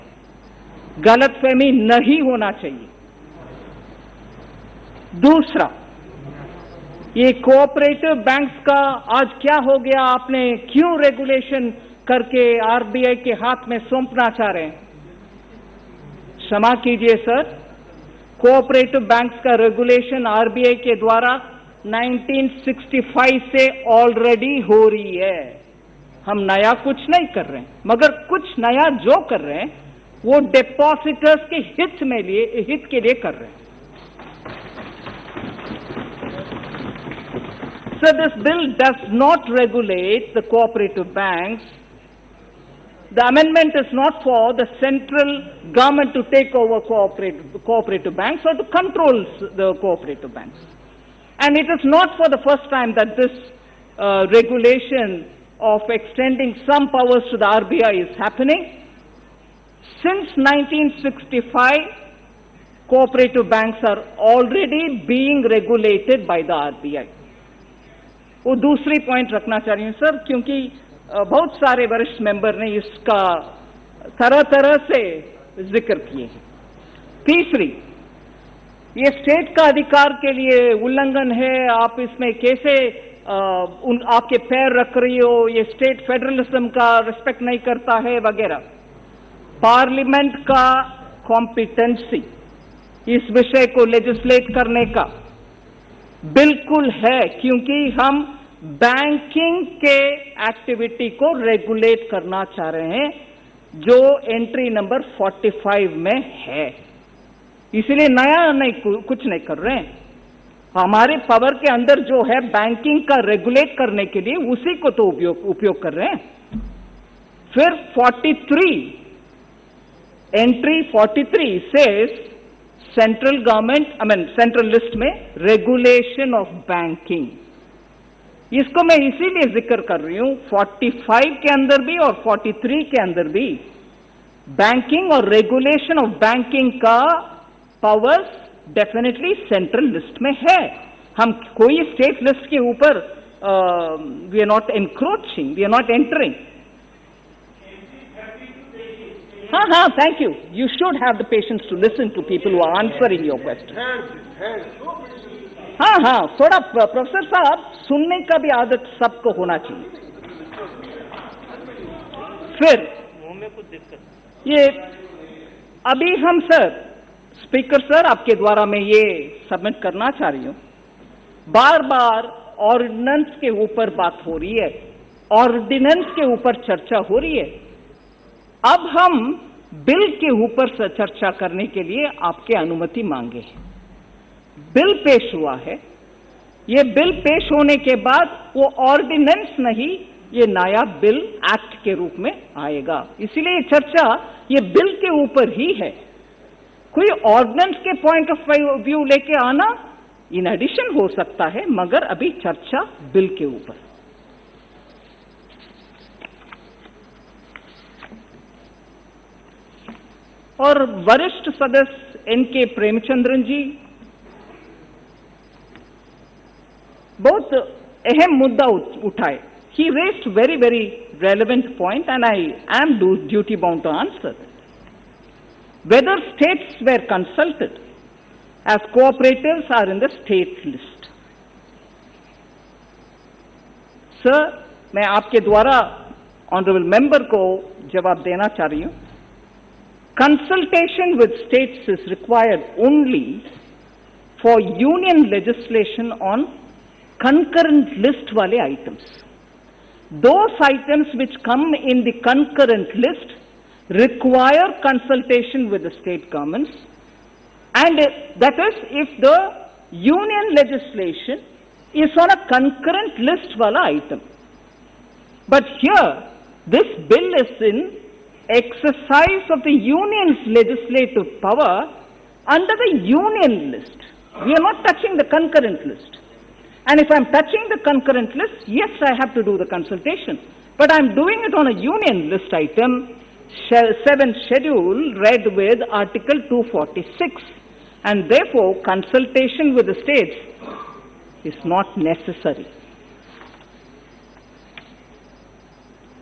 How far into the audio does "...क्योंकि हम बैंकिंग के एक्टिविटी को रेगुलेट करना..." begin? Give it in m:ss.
1:37.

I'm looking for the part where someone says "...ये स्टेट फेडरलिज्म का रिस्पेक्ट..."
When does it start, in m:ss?
1:25.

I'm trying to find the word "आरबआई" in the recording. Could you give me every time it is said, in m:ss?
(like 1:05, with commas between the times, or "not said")
0:12, 0:20.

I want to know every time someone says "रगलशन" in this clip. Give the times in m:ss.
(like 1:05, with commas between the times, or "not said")
0:11, 0:19, 2:05, 2:15.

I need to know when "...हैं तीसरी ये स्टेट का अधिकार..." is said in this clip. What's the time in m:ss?
1:16.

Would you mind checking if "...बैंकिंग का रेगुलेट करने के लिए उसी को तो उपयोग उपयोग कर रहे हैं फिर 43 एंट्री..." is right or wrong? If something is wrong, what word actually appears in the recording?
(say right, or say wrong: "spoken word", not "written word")
right.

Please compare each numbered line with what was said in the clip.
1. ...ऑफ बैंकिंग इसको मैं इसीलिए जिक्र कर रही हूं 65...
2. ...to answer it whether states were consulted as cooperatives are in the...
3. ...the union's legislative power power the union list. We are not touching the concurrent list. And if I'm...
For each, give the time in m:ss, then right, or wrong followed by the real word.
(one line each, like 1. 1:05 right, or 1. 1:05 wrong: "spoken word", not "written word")
1. 2:06 wrong: "45", not "65"
2. 3:43 right
3. 4:29 wrong: "under", not "power".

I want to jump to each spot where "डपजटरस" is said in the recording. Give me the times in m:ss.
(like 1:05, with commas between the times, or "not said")
0:30.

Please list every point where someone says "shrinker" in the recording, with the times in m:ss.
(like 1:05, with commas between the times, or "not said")
not said.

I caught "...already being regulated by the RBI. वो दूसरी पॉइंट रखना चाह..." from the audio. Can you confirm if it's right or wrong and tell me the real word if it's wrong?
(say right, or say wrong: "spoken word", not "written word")
right.